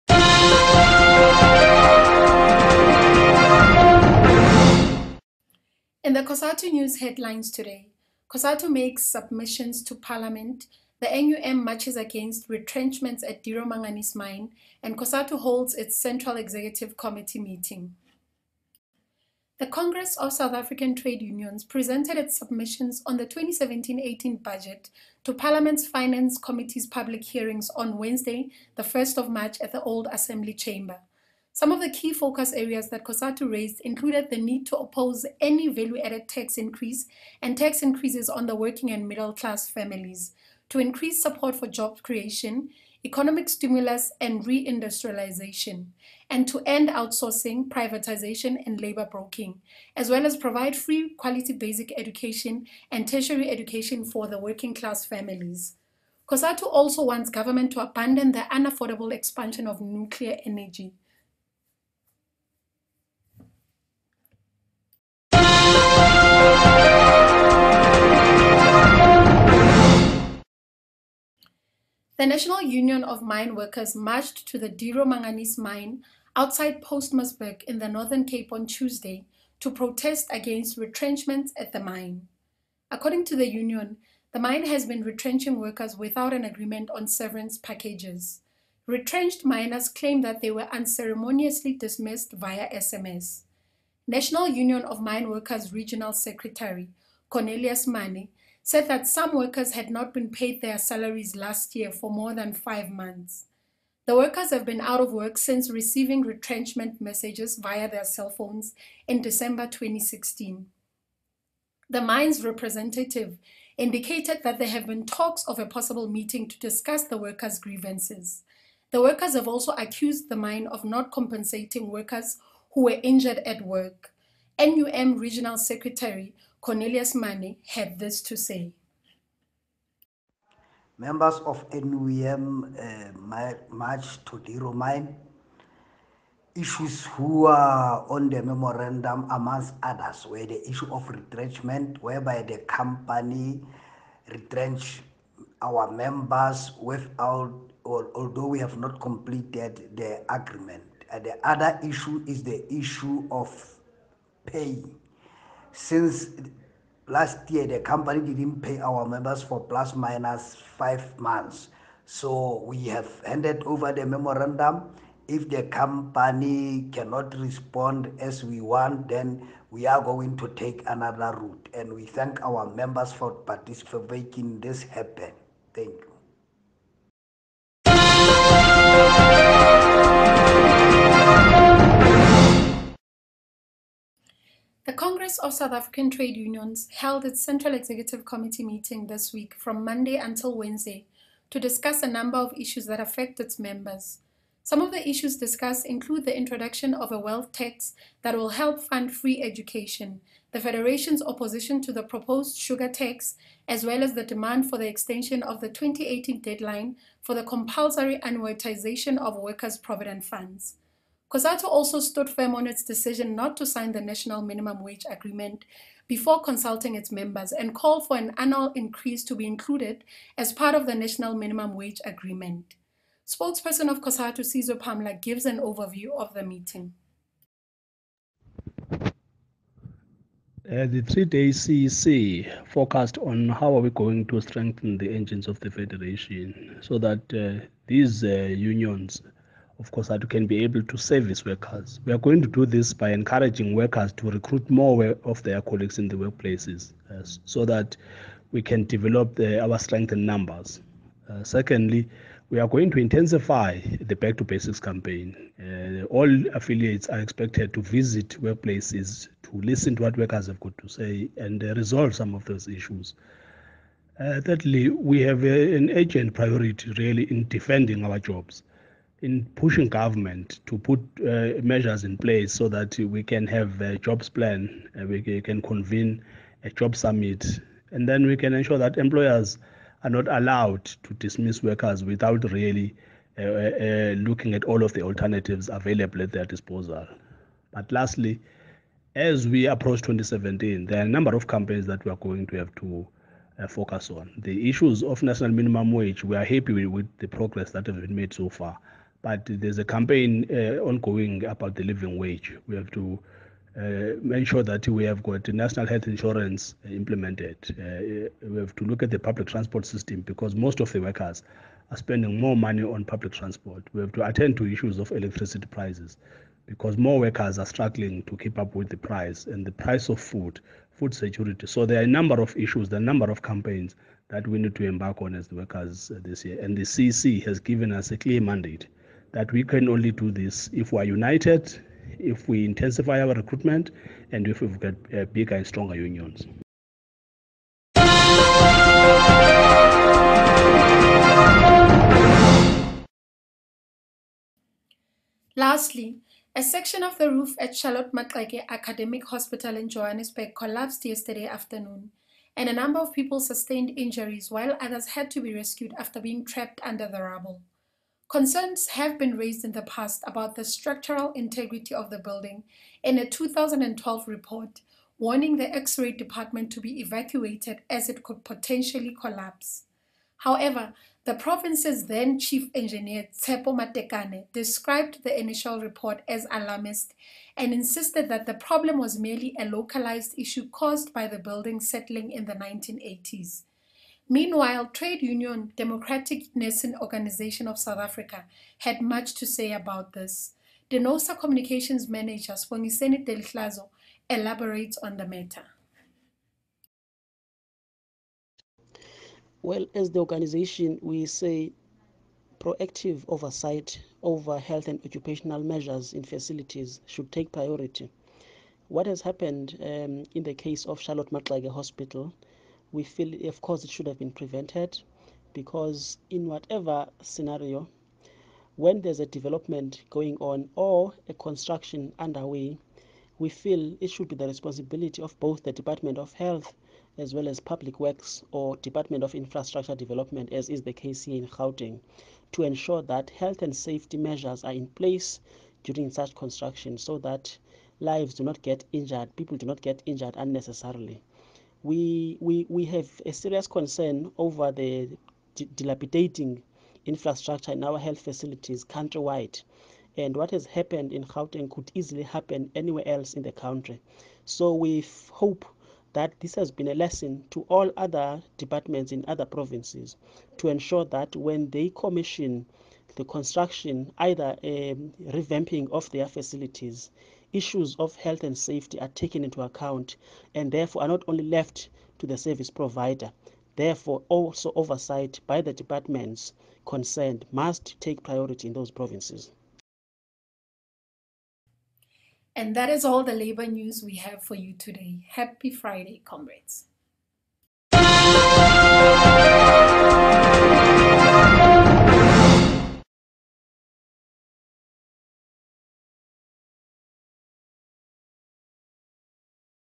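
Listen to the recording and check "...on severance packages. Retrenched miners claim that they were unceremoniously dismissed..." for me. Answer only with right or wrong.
right.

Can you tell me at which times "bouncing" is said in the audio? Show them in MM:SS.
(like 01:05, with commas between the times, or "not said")
not said.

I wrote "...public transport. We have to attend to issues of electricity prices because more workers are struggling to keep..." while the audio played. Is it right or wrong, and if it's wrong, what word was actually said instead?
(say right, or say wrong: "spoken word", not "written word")
right.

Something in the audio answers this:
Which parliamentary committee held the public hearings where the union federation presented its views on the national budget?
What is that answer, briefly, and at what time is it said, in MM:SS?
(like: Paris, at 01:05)
Finance Committee, at 00:25.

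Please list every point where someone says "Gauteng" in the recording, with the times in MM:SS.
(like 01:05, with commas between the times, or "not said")
07:11, 07:31.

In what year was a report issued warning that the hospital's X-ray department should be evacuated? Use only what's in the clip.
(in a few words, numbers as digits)
2012.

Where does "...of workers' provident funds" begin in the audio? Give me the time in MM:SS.
03:29.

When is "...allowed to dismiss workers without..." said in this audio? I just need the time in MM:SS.
04:40.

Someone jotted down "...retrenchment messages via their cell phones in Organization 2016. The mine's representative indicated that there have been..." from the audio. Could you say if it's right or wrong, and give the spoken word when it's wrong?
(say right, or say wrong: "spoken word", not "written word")
wrong: "December", not "Organization".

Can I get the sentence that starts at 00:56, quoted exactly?
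COSATU also wants government to abandon the unaffordable expansion of nuclear energy.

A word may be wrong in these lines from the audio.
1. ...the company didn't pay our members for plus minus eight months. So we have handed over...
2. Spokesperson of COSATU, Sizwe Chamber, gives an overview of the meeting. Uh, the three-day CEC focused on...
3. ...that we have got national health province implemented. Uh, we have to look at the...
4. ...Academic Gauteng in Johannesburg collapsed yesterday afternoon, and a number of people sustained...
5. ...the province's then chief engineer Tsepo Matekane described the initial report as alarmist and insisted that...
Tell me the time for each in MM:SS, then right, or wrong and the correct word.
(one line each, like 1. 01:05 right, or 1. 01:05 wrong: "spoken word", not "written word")
1. 02:37 wrong: "five", not "eight"
2. 03:43 wrong: "Pamla", not "Chamber"
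3. 05:04 wrong: "insurance", not "province"
4. 05:48 wrong: "Hospital", not "Gauteng"
5. 06:11 right.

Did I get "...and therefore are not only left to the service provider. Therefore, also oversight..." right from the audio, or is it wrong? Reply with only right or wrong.
right.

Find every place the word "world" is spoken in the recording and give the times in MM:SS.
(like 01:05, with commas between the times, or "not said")
not said.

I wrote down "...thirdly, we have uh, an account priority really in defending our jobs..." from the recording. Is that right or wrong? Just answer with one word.
wrong.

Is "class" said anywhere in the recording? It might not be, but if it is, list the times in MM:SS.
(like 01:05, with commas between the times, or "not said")
00:39, 00:54.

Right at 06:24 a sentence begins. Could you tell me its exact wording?
Meanwhile, trade union Democratic Nursing Organization of South Africa had much to say about this.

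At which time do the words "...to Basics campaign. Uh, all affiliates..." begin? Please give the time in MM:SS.
04:14.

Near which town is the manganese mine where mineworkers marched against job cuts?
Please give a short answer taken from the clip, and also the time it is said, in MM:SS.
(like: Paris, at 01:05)
Postmasburg, at 01:16.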